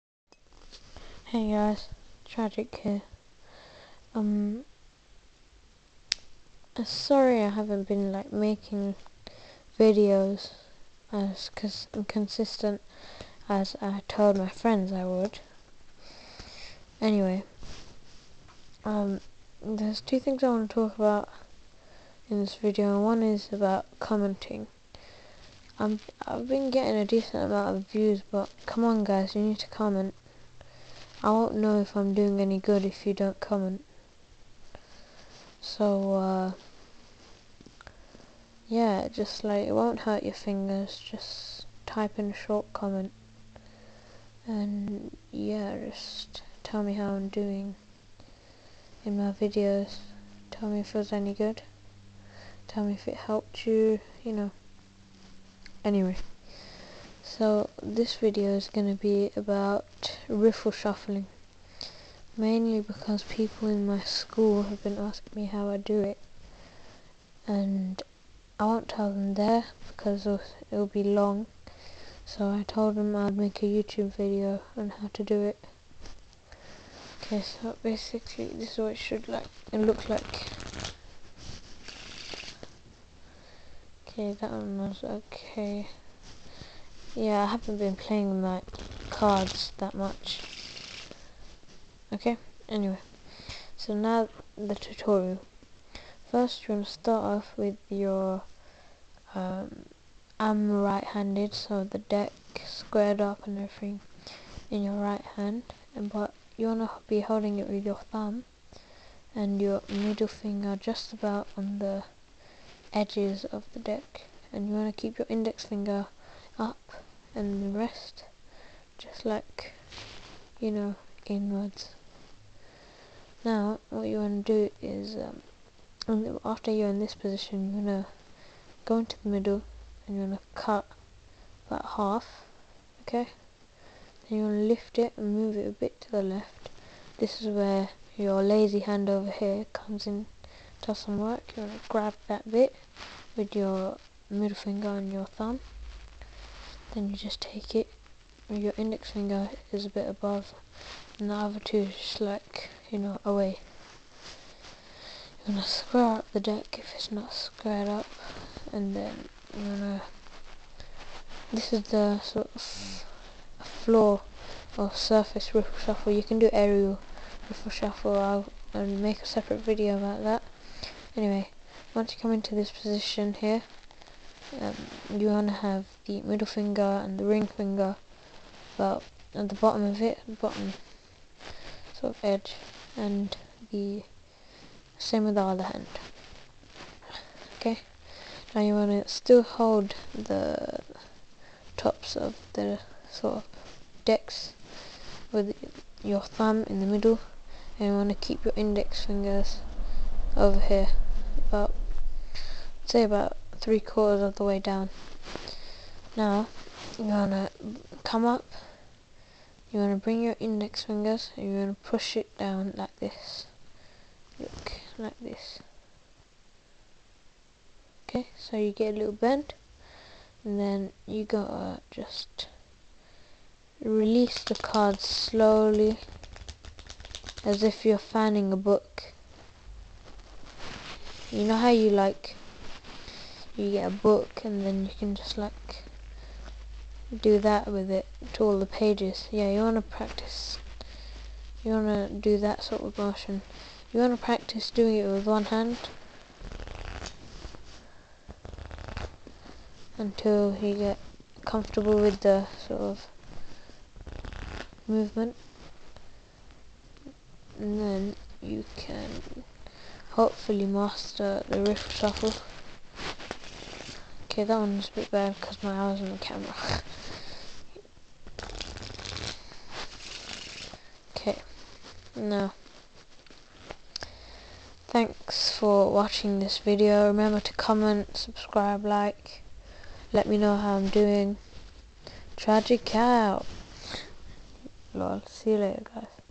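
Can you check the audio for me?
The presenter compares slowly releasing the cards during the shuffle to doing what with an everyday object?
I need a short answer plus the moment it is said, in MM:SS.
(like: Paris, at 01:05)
fanning a book, at 03:47.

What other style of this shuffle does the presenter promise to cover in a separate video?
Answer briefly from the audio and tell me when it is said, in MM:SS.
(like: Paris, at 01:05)
aerial riffle shuffle, at 02:46.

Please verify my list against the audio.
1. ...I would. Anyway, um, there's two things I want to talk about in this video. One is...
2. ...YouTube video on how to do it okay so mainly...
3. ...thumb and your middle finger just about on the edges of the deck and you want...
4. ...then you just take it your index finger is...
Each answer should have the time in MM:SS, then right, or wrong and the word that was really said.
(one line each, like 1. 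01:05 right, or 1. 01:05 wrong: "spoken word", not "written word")
1. 00:14 right
2. 01:13 wrong: "basically", not "mainly"
3. 01:48 right
4. 02:26 right.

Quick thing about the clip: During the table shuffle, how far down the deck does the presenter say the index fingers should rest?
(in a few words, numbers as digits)
three quarters.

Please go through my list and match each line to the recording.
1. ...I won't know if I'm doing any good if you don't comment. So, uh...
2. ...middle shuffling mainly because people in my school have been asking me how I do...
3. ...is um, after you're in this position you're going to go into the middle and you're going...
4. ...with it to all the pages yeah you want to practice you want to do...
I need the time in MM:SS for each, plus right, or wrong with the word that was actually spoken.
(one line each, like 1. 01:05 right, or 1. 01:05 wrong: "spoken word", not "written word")
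1. 00:31 right
2. 01:00 wrong: "riffle", not "middle"
3. 02:04 right
4. 03:57 right.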